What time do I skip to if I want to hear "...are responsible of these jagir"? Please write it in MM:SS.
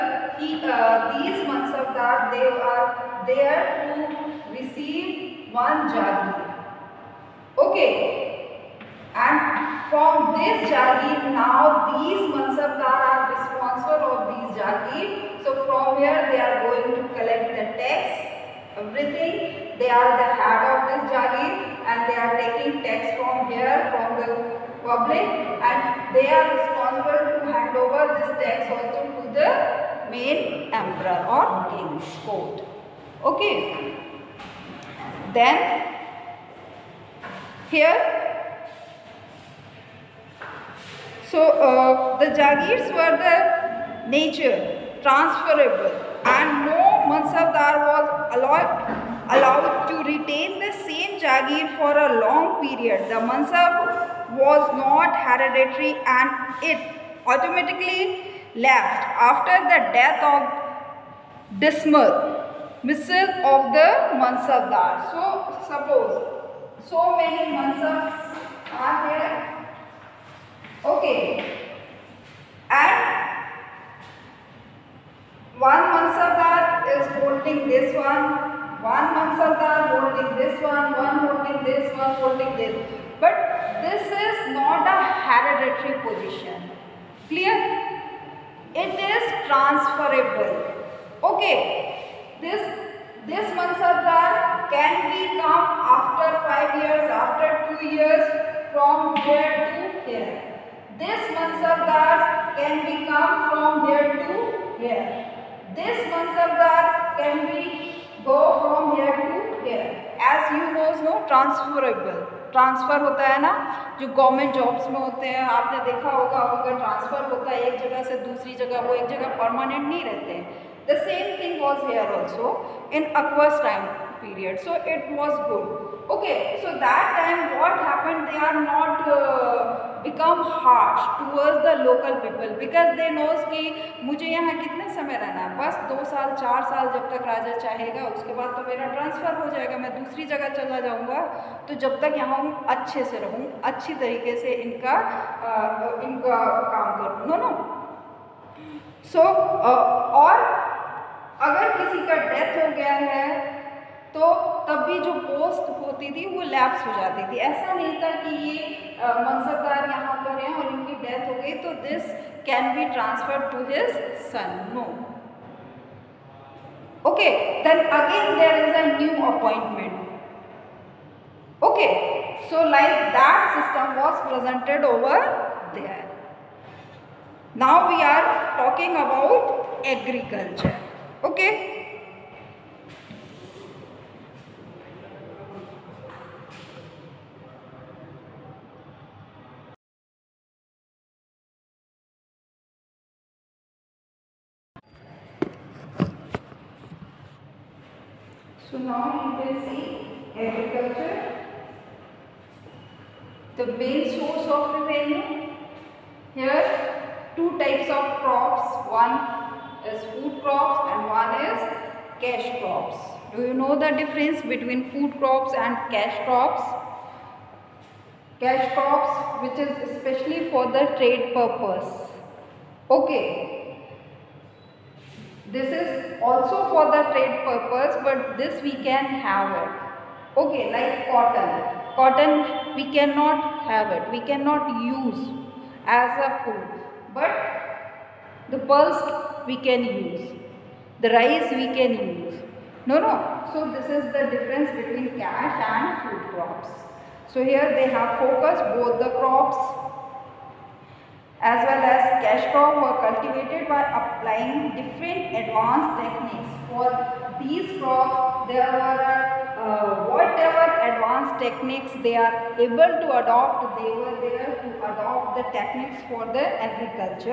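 00:13.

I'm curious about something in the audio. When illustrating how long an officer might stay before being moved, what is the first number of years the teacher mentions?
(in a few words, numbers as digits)
5 years.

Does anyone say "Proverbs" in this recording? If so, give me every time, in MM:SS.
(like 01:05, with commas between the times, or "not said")
not said.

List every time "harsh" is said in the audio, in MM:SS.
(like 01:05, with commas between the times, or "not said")
02:10.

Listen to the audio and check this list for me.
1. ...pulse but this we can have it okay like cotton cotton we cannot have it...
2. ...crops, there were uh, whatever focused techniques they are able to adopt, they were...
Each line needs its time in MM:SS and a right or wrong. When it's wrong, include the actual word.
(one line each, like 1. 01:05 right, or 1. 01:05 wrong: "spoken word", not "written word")
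1. 03:47 wrong: "purpose", not "pulse"
2. 04:17 wrong: "advanced", not "focused".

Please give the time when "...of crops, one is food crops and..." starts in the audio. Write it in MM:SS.
03:27.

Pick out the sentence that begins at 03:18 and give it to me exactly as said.
So now we will see agriculture the main source of revenue.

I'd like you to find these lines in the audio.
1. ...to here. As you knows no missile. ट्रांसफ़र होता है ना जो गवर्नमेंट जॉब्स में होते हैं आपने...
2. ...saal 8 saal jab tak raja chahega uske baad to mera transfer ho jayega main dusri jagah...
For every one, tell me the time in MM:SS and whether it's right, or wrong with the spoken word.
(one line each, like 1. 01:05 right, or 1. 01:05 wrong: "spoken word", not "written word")
1. 01:49 wrong: "transferable", not "missile"
2. 02:16 wrong: "4", not "8".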